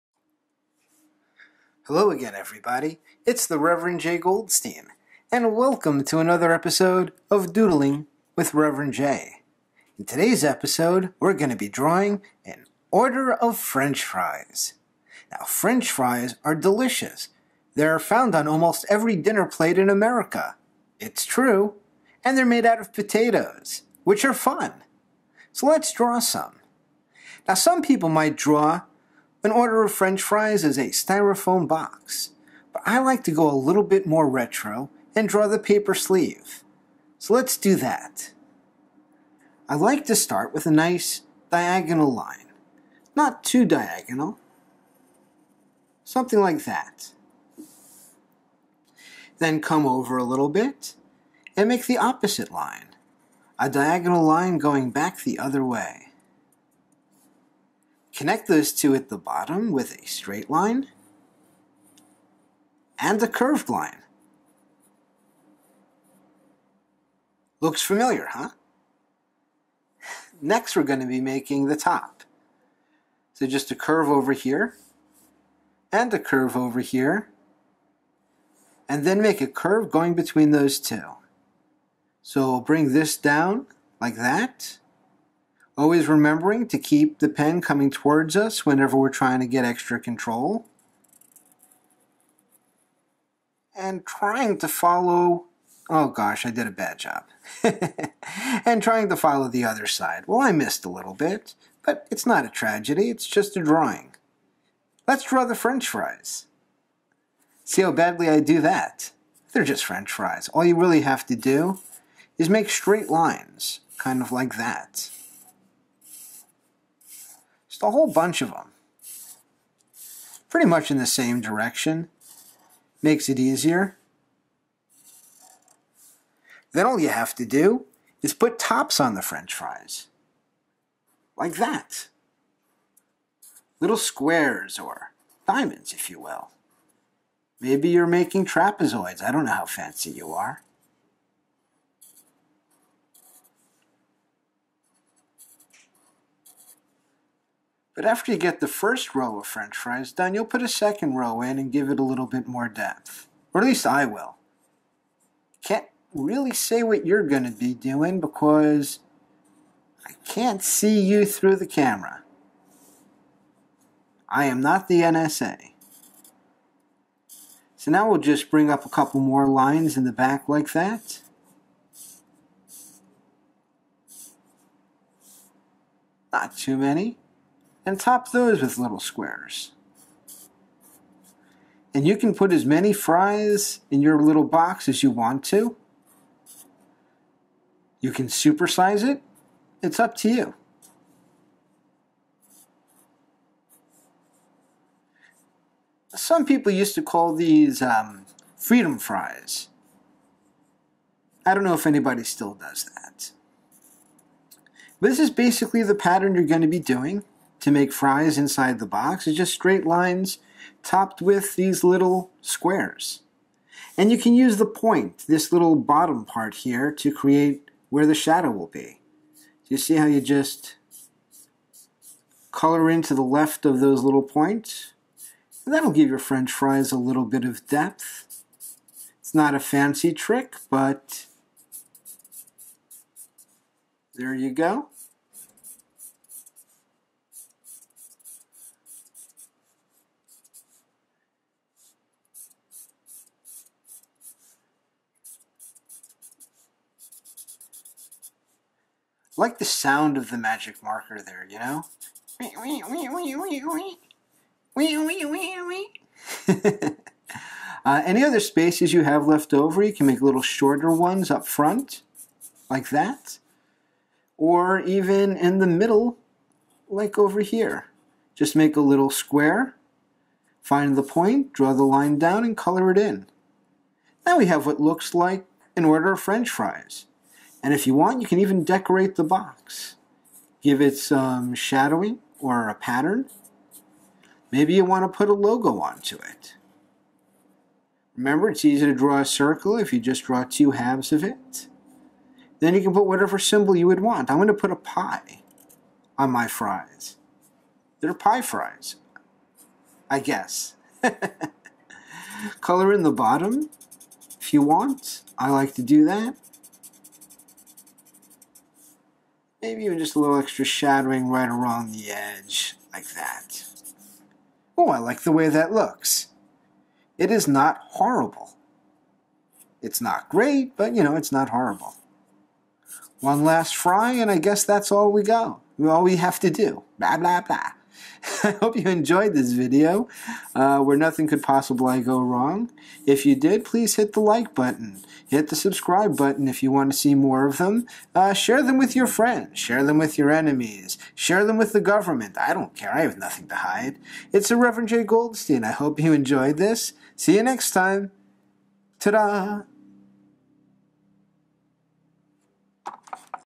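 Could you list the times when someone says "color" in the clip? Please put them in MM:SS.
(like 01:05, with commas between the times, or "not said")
03:42, 04:32, 05:02.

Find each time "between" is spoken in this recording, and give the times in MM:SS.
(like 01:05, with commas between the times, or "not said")
01:20.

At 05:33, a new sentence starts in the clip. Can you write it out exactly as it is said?
If you did, please hit the like button.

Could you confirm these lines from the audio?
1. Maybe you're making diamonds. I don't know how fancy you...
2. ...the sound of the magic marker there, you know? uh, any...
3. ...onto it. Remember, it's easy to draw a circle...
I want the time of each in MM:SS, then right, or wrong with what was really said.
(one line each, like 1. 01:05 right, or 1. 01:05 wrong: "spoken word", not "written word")
1. 02:17 wrong: "trapezoids", not "diamonds"
2. 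04:09 right
3. 04:45 right.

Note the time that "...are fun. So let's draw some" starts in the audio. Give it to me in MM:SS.
00:24.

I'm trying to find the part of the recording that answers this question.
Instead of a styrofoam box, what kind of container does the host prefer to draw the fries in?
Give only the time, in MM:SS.
00:35.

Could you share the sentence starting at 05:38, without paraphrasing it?
Uh, share them with your friends.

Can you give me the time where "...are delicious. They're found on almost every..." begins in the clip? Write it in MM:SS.
00:16.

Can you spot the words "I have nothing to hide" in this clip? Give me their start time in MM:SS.
05:42.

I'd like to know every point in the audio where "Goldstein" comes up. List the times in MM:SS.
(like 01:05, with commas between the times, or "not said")
00:04, 05:45.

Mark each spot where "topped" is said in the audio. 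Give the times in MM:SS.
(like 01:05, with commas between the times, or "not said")
03:30.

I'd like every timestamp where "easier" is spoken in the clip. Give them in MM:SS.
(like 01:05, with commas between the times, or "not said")
02:03.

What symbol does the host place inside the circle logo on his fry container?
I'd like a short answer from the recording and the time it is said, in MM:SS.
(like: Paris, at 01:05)
A pie, at 04:54.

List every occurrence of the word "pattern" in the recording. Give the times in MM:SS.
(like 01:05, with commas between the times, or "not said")
03:25, 04:42.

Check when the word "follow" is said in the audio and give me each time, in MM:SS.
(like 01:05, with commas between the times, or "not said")
01:34, 01:39.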